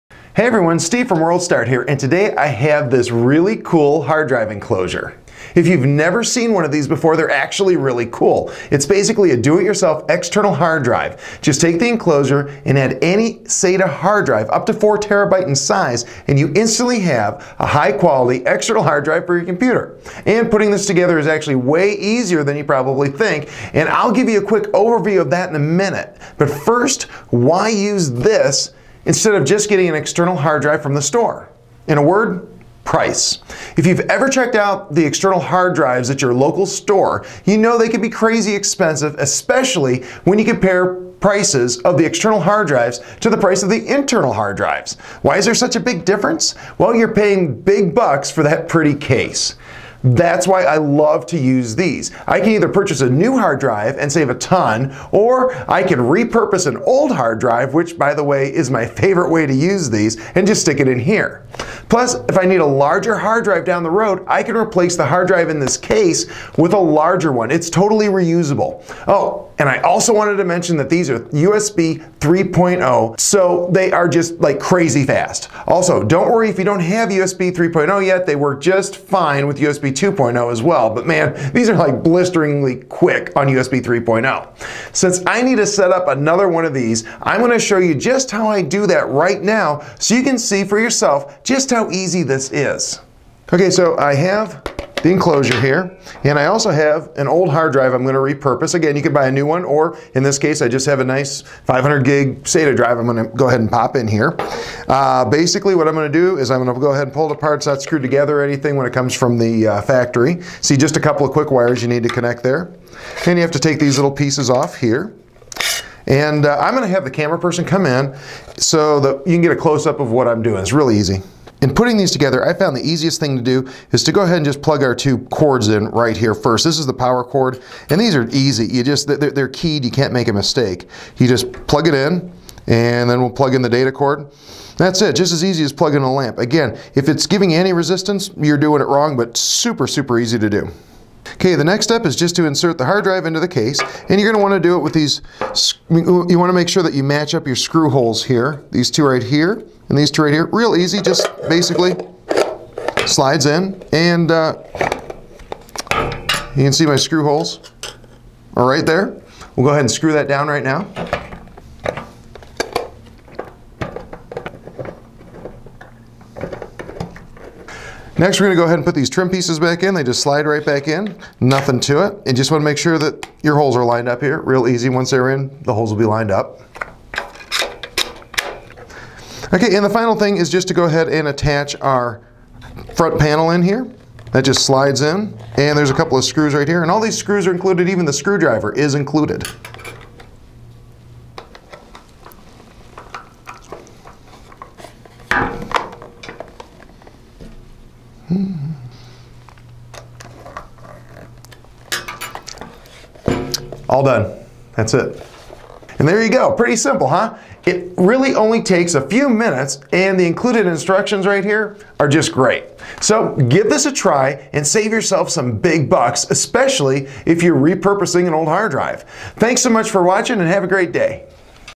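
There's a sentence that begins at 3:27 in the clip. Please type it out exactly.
It really only takes a few minutes and the included instructions right here are just great.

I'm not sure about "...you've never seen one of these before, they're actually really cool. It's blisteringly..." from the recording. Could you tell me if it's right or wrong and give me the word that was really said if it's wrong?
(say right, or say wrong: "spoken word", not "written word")
wrong: "basically", not "blisteringly".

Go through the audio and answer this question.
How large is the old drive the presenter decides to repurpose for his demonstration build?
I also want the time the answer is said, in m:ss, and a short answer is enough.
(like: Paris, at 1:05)
500 gig, at 1:41.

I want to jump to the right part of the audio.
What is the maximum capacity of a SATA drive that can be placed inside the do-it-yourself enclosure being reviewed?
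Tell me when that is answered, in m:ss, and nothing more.
0:14.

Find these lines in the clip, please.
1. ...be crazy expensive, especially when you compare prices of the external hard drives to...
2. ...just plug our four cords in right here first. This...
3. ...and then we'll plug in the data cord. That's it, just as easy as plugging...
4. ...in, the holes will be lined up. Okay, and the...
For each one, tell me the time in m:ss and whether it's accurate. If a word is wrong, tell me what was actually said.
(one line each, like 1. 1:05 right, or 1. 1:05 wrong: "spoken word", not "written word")
1. 0:38 right
2. 2:04 wrong: "two", not "four"
3. 2:12 right
4. 2:55 right.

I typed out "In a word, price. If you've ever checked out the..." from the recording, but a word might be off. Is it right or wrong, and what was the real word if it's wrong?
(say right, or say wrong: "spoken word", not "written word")
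right.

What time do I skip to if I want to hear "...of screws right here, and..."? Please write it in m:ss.
3:06.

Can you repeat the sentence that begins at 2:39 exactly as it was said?
We'll go ahead and screw that down right now.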